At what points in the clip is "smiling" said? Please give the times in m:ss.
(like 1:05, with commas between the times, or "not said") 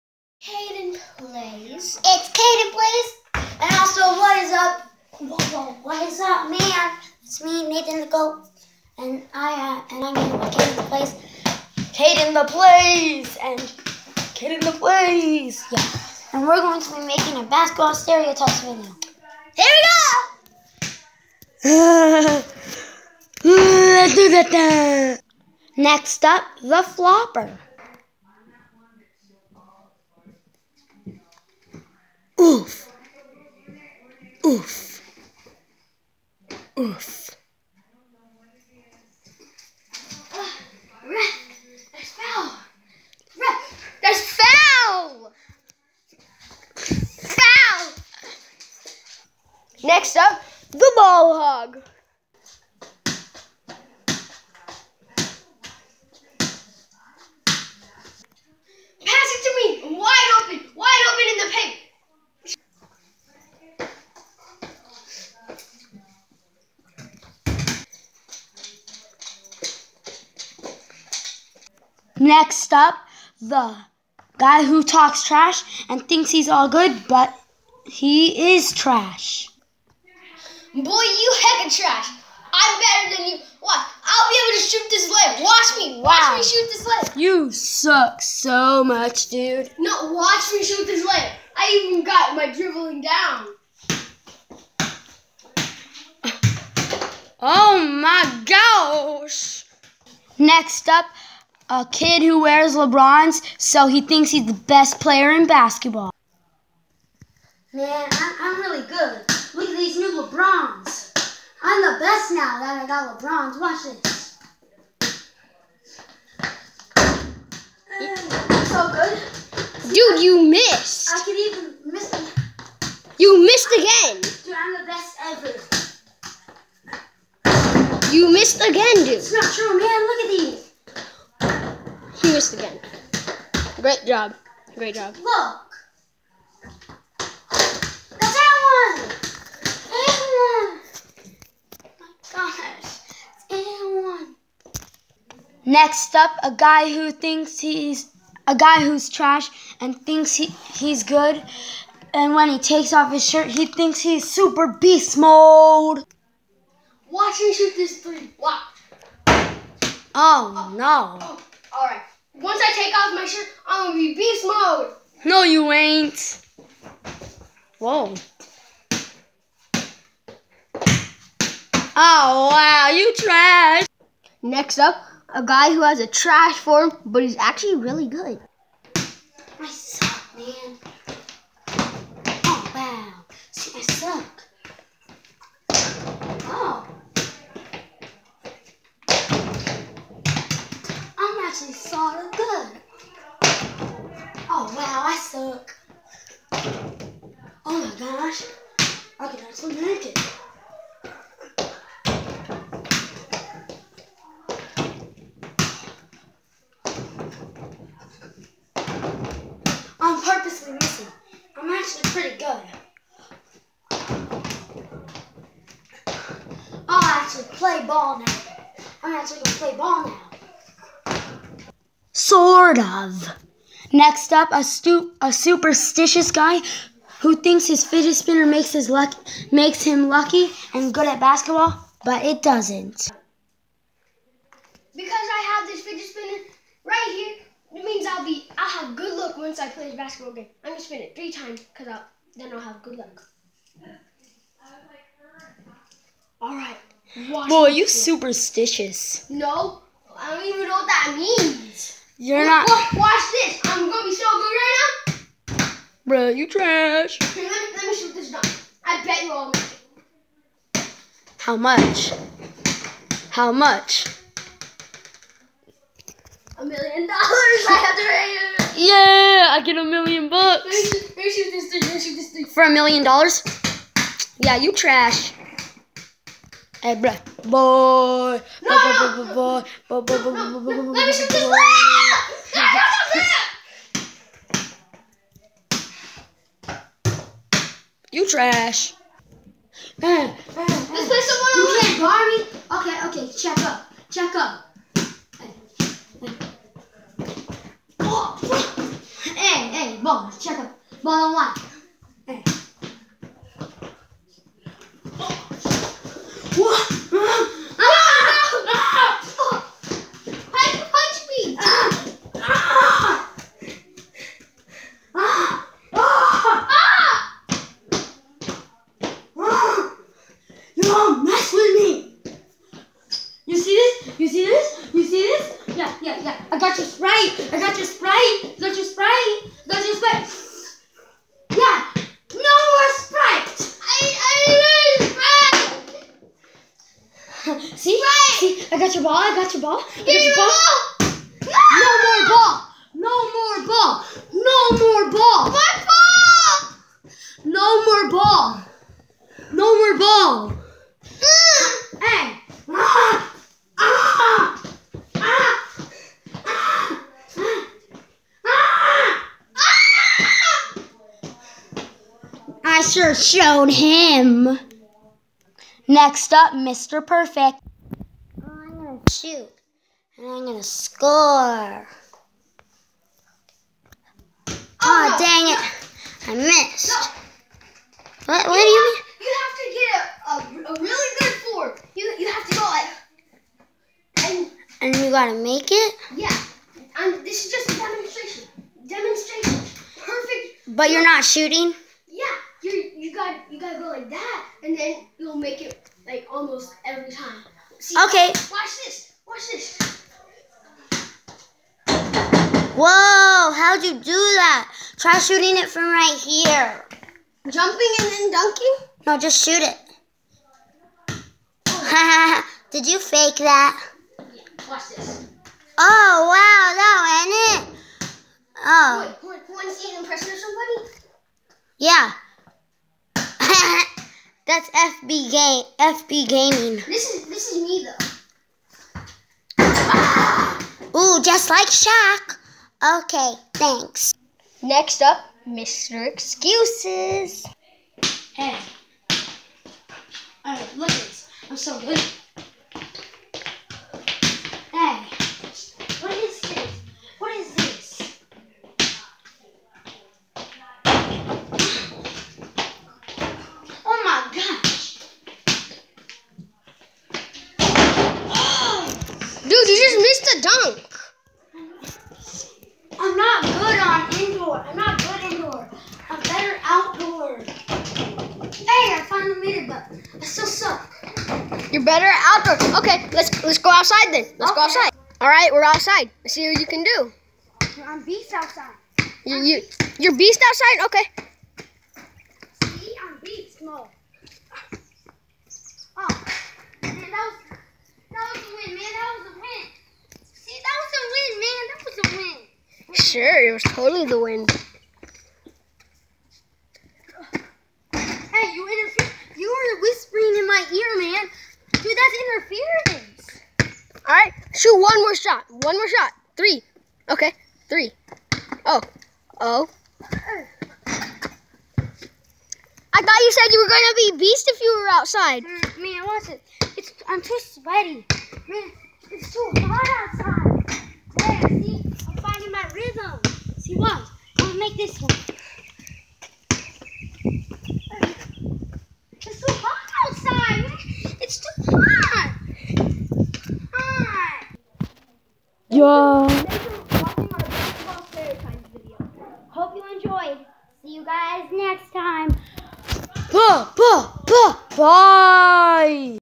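not said.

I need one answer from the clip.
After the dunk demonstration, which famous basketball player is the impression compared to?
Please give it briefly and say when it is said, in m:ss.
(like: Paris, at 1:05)
Shaq, at 7:11.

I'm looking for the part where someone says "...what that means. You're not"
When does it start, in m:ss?
4:10.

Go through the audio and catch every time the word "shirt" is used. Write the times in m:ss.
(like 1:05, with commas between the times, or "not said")
2:33, 2:43.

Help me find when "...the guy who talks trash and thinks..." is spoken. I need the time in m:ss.
1:13.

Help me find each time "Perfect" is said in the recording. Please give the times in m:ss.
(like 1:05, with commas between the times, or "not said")
6:07, 6:30.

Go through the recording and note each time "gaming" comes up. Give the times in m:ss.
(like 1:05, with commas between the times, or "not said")
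7:06.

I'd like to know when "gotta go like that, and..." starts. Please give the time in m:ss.
6:33.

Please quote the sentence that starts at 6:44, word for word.
Try shooting it from right here.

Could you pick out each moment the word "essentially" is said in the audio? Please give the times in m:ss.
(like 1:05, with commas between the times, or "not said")
not said.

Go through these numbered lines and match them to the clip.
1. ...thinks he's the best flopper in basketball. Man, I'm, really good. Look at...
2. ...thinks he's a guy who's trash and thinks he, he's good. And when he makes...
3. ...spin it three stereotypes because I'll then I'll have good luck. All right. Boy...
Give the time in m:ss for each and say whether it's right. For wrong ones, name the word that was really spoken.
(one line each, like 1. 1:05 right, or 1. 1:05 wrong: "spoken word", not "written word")
1. 1:44 wrong: "player", not "flopper"
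2. 2:27 wrong: "takes", not "makes"
3. 4:00 wrong: "times", not "stereotypes".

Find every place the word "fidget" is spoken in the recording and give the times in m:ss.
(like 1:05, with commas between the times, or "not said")
3:47, 3:55.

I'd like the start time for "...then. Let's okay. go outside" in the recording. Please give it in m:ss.
7:54.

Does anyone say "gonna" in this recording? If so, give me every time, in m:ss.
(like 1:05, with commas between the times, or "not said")
2:43, 3:39, 4:00, 4:13, 8:33.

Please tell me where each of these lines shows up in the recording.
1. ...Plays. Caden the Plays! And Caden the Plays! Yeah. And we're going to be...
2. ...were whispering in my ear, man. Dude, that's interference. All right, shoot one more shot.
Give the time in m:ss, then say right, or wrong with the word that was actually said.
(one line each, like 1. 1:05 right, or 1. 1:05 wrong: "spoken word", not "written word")
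1. 0:10 right
2. 8:19 right.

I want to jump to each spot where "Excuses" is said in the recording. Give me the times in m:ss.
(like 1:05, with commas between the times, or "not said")
7:16.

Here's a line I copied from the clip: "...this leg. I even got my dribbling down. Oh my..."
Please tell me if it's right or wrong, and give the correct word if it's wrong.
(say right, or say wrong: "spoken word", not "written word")
right.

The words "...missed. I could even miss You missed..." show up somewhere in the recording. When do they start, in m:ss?
2:00.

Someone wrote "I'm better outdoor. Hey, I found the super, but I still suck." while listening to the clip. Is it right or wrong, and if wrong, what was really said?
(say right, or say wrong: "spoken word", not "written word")
wrong: "meter", not "super".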